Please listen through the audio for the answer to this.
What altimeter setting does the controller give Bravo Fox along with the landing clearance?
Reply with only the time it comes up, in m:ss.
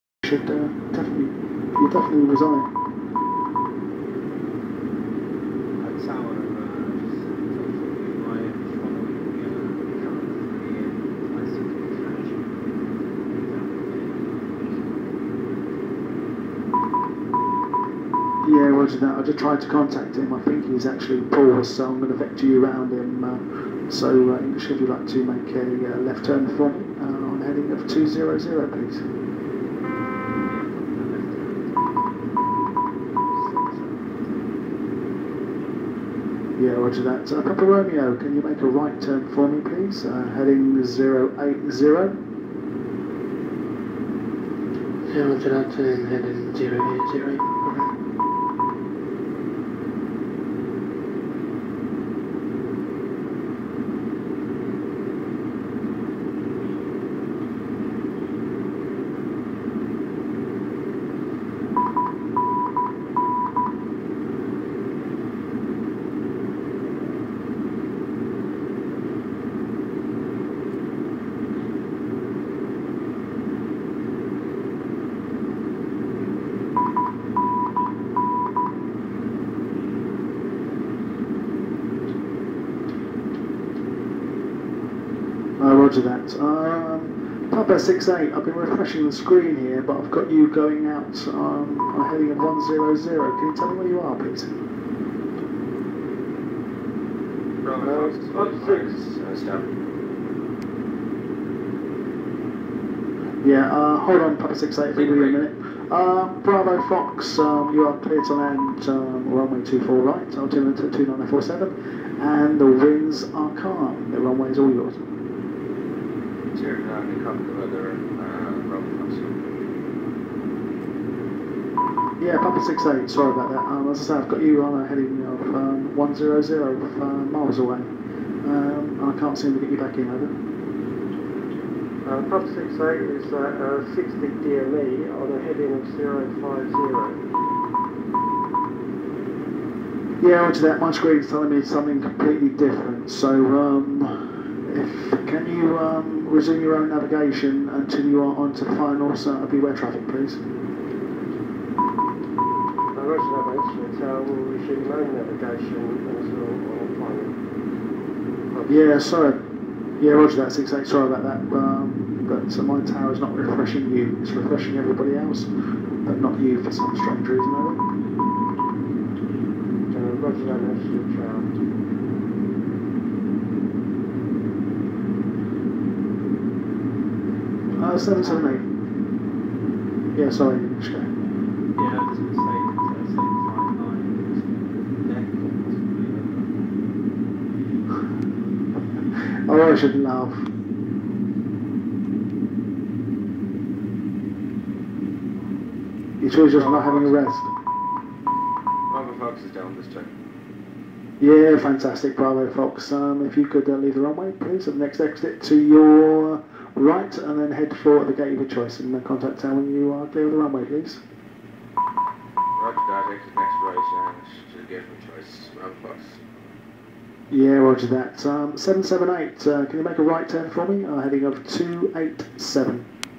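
1:50.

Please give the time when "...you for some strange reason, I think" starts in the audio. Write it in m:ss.
2:46.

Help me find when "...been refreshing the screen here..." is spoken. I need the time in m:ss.
1:28.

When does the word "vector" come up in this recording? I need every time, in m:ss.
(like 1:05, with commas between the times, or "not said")
0:22.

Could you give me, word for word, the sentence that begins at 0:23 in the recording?
Uh, so, uh, English, if you'd like to make a uh, left turn for me uh, on heading of 200, please.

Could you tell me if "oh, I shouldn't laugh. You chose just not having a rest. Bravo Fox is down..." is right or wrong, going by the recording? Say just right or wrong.
right.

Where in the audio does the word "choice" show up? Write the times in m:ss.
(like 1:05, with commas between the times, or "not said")
3:28, 3:35.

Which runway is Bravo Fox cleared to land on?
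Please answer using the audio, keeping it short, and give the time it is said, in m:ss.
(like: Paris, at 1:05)
24 right, at 1:49.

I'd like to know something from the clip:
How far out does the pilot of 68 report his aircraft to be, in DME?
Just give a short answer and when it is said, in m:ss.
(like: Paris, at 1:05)
60 DME, at 2:13.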